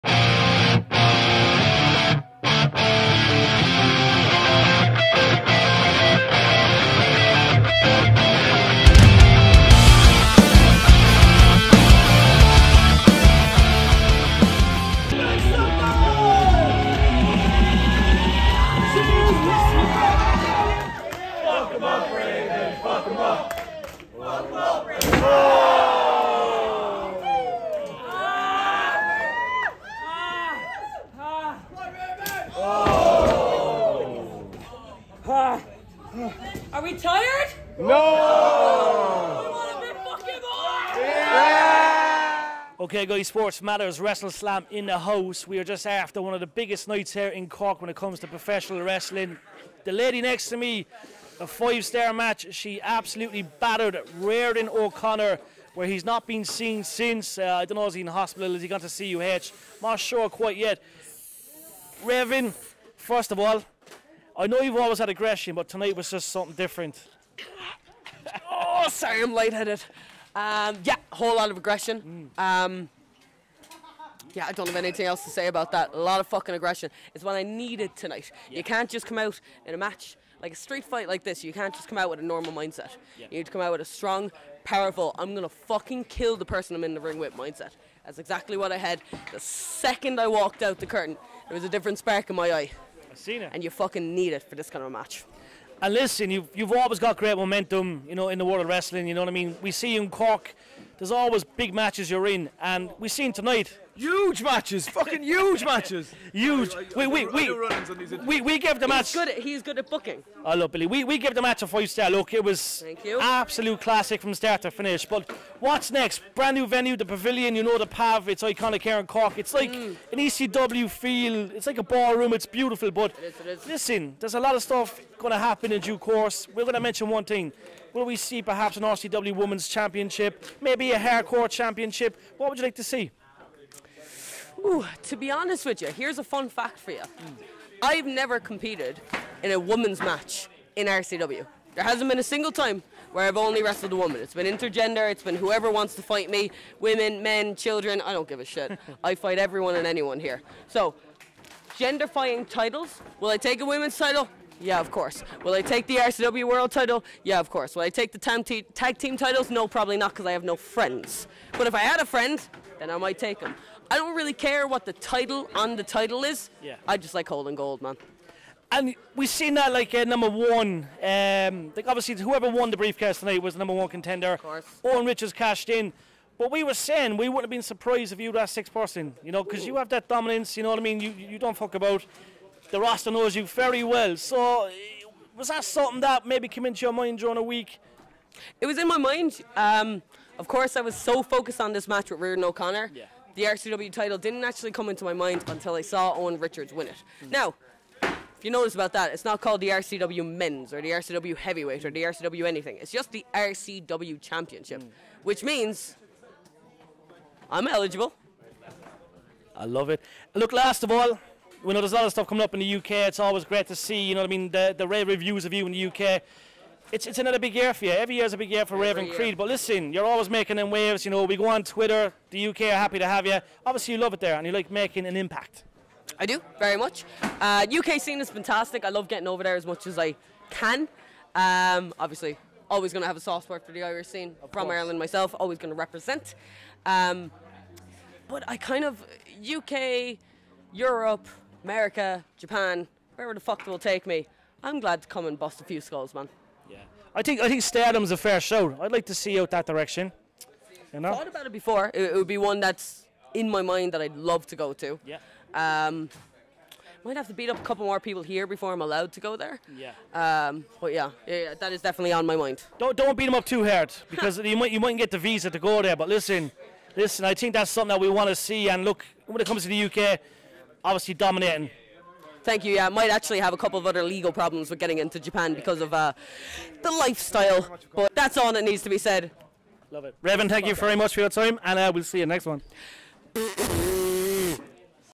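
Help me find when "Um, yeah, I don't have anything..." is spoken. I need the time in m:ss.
1:12.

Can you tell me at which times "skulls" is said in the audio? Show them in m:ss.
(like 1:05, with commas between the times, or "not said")
4:05.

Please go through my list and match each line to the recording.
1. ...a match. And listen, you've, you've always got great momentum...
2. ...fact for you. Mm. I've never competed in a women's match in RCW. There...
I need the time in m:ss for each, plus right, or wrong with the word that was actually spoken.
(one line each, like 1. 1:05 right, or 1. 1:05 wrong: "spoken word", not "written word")
1. 1:34 right
2. 2:16 right.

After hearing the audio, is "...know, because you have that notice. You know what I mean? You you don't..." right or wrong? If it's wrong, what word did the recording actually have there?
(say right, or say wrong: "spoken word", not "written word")
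wrong: "dominance", not "notice".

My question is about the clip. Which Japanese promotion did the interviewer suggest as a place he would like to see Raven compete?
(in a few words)
Stardom.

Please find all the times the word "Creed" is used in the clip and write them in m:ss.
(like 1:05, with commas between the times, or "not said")
3:39.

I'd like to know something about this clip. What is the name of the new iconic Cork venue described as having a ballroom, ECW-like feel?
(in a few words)
The Pavilion.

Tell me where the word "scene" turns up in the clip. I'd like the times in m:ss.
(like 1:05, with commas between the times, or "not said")
3:48, 3:54.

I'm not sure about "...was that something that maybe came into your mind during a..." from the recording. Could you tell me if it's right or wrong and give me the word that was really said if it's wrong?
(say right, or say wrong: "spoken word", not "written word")
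right.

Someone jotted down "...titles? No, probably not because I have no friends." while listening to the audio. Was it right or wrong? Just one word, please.
right.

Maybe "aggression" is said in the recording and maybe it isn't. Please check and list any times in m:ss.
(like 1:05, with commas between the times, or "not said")
1:05, 1:11, 1:16.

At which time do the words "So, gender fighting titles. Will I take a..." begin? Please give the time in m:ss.
2:30.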